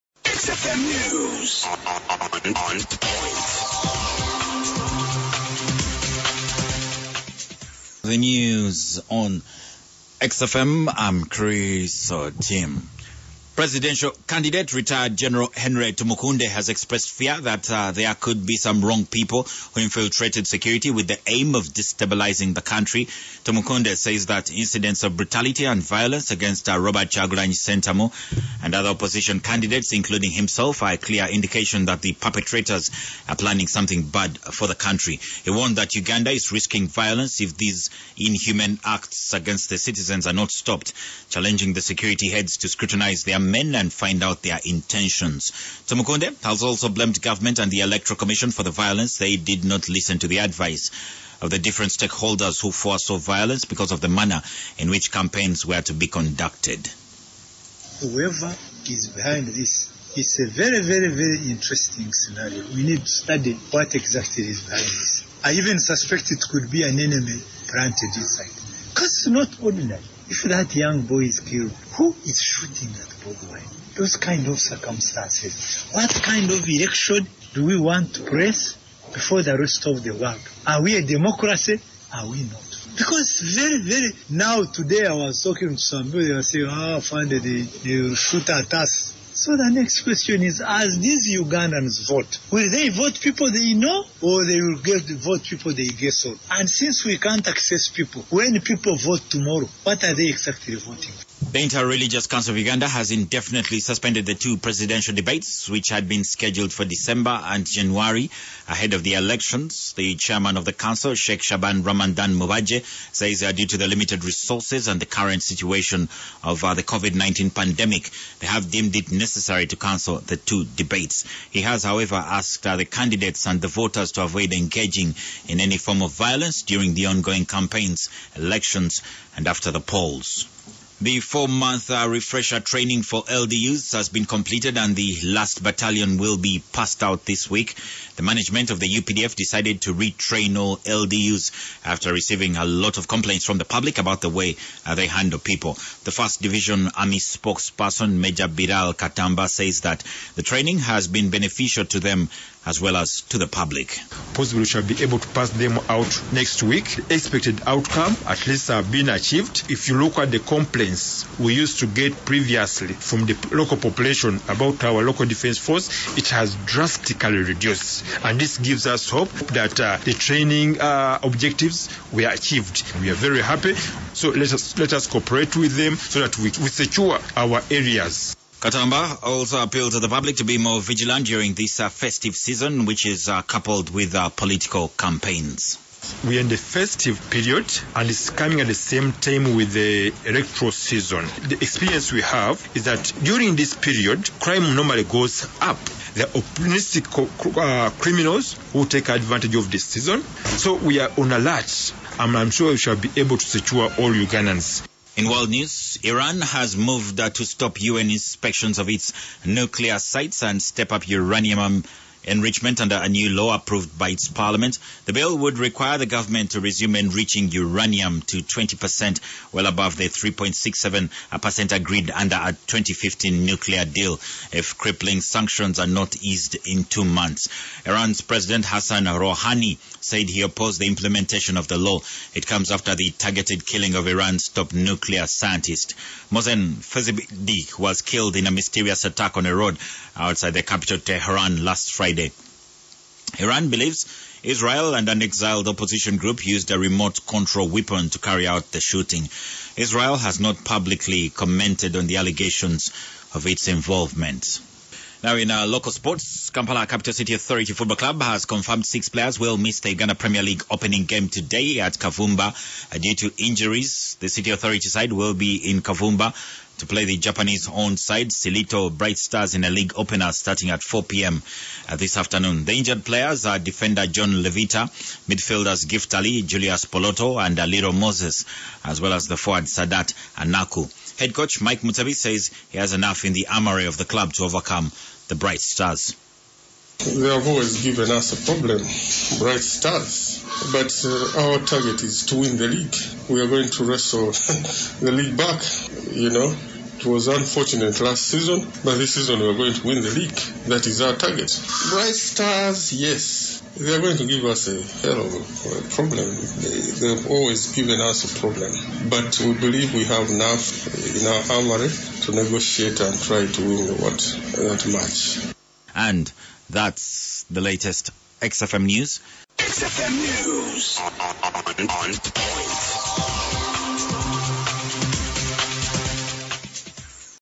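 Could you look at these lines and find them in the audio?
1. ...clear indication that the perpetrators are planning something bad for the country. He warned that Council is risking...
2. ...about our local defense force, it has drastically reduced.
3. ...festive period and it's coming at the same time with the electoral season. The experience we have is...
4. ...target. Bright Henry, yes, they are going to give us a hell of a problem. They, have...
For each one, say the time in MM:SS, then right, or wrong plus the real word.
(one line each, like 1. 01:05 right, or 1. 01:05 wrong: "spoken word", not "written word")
1. 00:30 wrong: "Uganda", not "Council"
2. 02:44 right
3. 03:06 right
4. 05:01 wrong: "Stars", not "Henry".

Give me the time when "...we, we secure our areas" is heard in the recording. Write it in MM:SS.
02:56.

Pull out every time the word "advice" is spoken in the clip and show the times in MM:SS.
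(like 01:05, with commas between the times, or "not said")
00:50.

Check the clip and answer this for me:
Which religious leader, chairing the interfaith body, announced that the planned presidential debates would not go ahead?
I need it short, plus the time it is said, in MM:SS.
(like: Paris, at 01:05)
Sheikh Shaban Ramadan Mubaje, at 01:51.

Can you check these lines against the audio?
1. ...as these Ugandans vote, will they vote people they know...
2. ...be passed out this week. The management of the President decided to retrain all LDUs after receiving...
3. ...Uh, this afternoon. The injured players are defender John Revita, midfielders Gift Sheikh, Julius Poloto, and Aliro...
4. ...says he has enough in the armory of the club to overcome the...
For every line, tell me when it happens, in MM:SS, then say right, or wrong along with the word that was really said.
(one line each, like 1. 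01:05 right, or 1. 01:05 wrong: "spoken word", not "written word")
1. 01:30 right
2. 02:16 wrong: "UPDF", not "President"
3. 04:31 wrong: "Ali", not "Sheikh"
4. 04:42 right.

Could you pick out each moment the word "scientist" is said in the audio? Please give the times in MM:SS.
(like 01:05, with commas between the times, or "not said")
03:55.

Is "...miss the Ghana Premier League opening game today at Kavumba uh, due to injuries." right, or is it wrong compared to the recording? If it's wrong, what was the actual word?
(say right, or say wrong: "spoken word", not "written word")
right.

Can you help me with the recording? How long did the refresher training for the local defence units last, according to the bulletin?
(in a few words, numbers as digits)
4 months.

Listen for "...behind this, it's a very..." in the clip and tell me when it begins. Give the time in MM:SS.
00:59.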